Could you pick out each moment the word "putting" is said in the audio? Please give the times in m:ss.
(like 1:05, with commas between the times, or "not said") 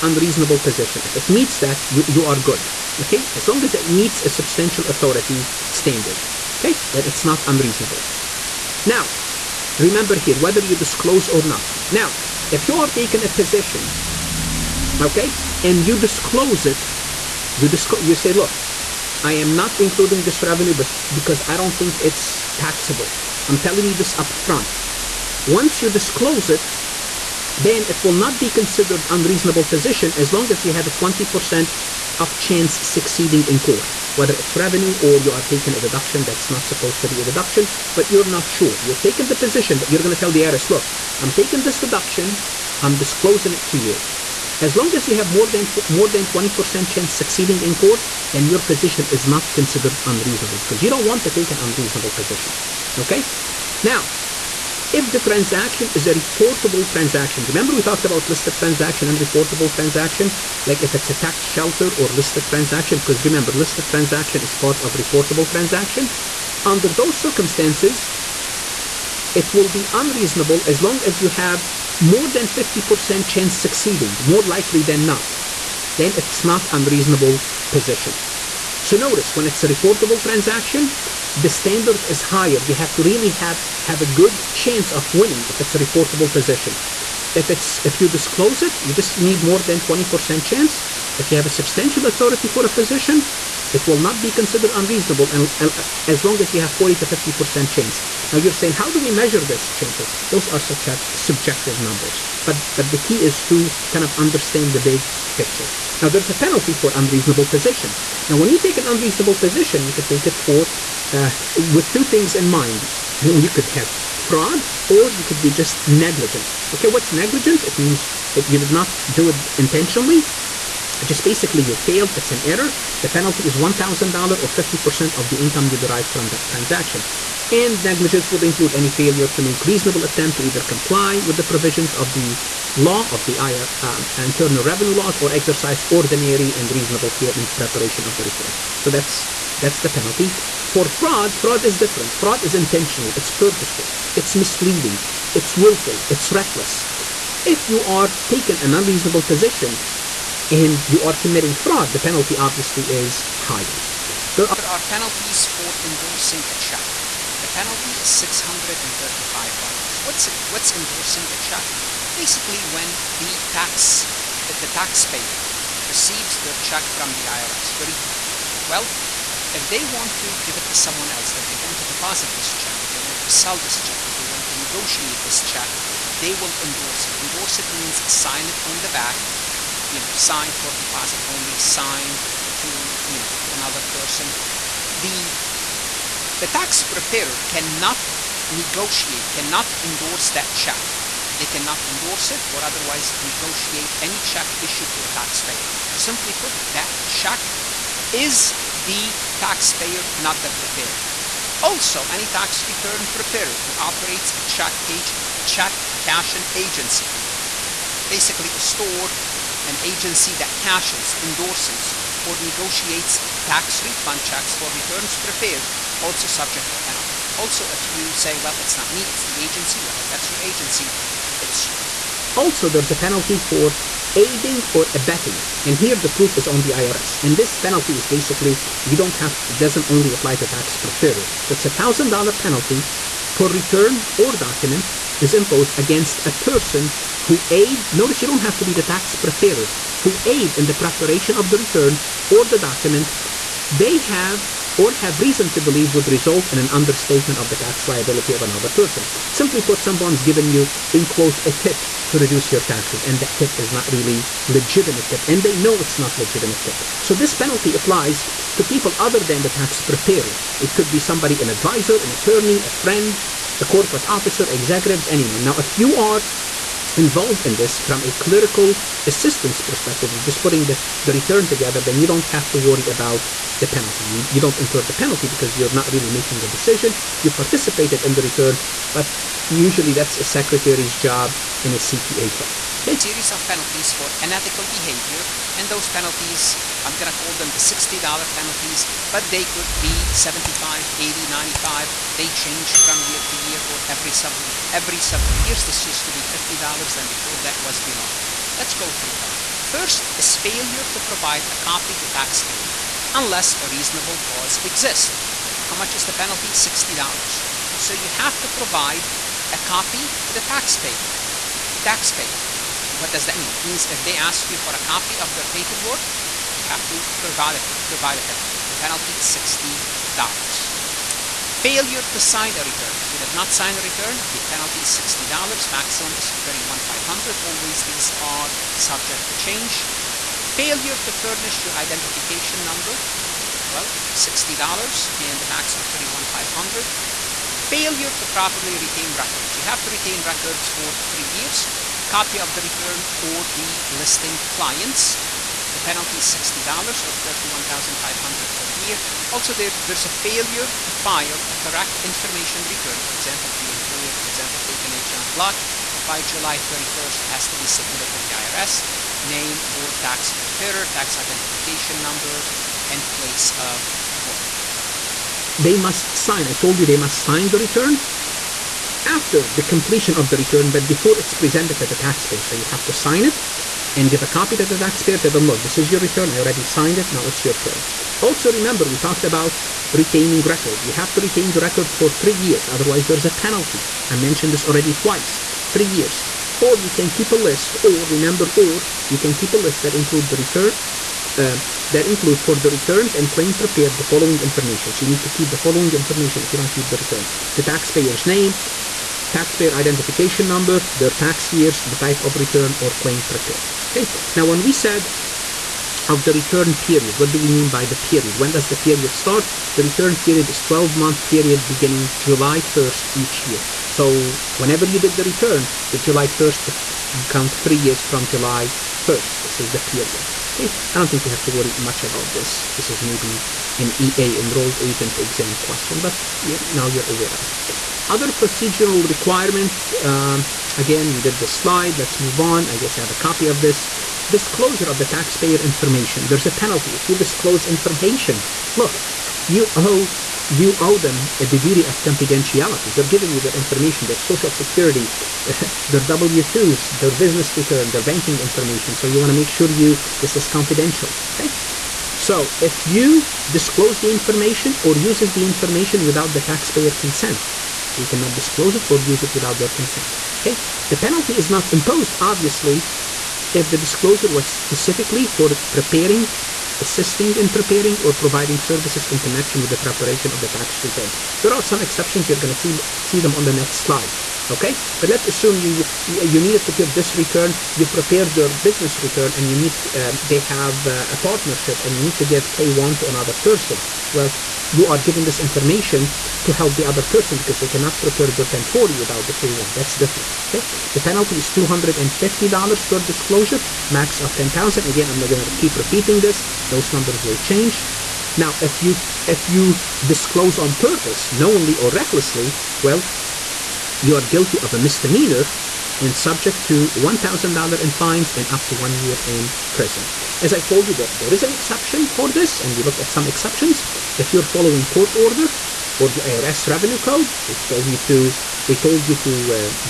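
4:30.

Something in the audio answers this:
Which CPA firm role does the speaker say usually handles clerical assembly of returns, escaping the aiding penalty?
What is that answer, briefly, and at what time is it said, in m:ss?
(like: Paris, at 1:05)
secretary, at 4:40.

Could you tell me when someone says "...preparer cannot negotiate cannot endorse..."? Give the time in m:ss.
3:06.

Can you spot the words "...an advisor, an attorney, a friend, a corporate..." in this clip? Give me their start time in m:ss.
4:21.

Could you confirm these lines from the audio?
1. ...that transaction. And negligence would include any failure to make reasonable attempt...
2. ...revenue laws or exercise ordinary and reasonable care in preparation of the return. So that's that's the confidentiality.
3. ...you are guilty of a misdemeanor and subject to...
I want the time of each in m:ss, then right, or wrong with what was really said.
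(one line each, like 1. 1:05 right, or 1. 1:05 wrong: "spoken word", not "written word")
1. 2:06 right
2. 2:14 wrong: "penalty", not "confidentiality"
3. 8:23 right.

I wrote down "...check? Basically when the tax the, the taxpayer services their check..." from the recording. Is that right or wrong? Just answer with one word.
wrong.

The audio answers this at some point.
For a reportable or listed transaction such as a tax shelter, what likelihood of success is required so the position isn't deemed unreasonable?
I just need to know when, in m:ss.
1:11.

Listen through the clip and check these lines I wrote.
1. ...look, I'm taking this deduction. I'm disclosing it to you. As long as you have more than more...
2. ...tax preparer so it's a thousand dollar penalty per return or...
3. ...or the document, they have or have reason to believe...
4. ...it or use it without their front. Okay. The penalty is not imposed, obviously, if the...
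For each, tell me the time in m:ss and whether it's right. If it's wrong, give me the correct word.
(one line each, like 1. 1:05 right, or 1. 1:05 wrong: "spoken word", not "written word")
1. 0:40 right
2. 3:50 right
3. 4:02 right
4. 7:38 wrong: "consent", not "front".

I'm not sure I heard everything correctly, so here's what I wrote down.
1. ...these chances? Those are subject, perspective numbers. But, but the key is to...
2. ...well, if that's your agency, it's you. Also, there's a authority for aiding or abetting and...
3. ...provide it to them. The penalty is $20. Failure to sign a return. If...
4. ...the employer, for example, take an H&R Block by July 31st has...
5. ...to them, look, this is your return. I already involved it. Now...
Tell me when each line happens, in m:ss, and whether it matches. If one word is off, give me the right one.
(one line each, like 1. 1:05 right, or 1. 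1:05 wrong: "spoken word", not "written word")
1. 1:39 wrong: "subjective", not "perspective"
2. 3:39 wrong: "penalty", not "authority"
3. 5:17 wrong: "60", not "20"
4. 5:53 right
5. 6:15 wrong: "signed", not "involved".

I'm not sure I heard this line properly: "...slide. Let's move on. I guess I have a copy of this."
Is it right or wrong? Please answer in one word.
right.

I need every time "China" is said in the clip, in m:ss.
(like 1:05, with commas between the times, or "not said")
not said.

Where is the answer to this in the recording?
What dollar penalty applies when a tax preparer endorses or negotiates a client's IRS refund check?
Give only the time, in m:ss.
2:38.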